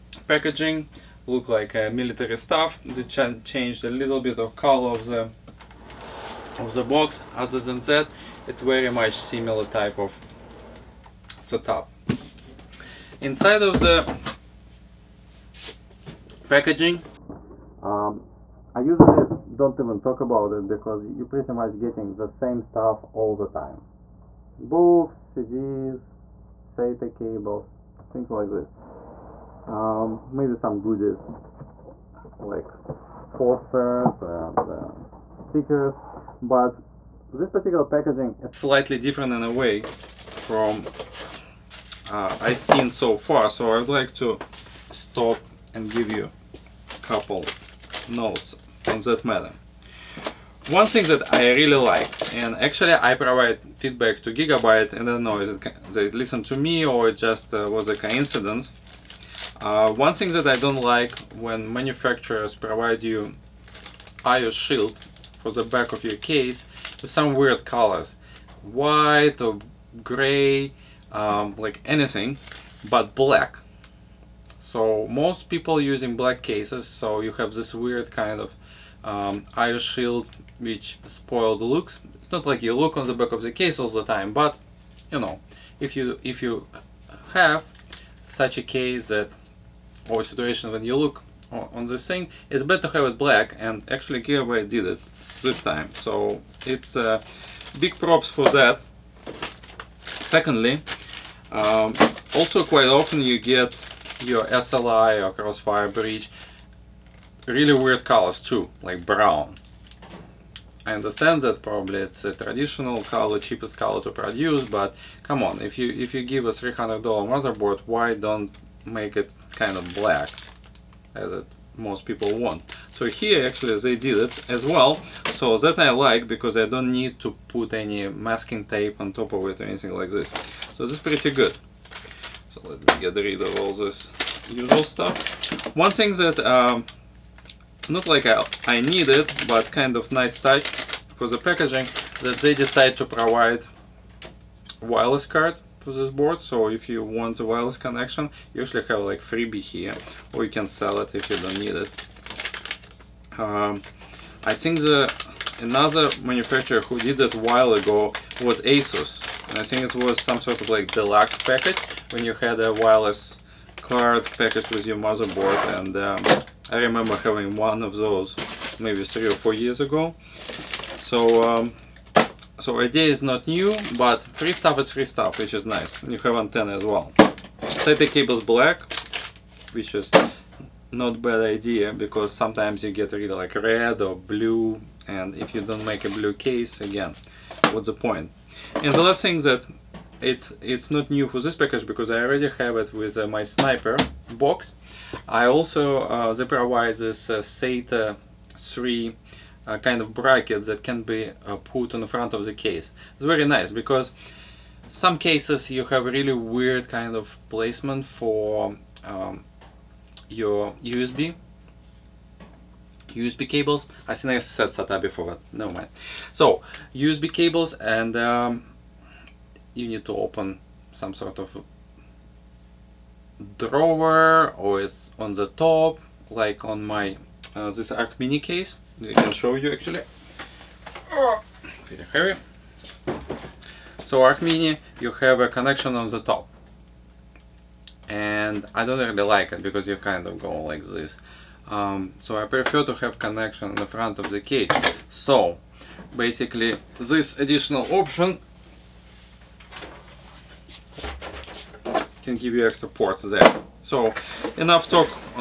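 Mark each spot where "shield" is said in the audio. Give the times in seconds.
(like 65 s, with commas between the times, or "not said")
64 s, 79 s.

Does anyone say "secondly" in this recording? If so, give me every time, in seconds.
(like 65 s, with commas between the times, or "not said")
100 s.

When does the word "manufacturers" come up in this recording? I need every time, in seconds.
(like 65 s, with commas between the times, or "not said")
61 s, 156 s.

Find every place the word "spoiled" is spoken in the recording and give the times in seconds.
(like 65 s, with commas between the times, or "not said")
81 s.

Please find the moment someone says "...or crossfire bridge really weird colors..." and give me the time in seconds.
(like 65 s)
105 s.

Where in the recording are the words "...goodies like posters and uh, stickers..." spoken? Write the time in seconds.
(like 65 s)
30 s.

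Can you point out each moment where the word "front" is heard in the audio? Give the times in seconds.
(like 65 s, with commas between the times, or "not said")
202 s, 243 s.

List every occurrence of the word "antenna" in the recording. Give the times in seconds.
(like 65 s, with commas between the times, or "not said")
176 s.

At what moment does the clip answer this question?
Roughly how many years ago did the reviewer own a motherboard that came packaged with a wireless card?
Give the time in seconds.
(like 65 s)
169 s.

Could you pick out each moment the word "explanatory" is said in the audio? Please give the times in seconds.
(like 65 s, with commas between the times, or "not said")
not said.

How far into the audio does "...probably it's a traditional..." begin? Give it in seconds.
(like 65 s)
111 s.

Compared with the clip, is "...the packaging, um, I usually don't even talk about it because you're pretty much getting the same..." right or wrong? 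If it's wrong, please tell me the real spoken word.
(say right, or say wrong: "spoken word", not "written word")
right.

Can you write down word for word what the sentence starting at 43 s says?
So I would like to stop and give you a couple notes on that matter.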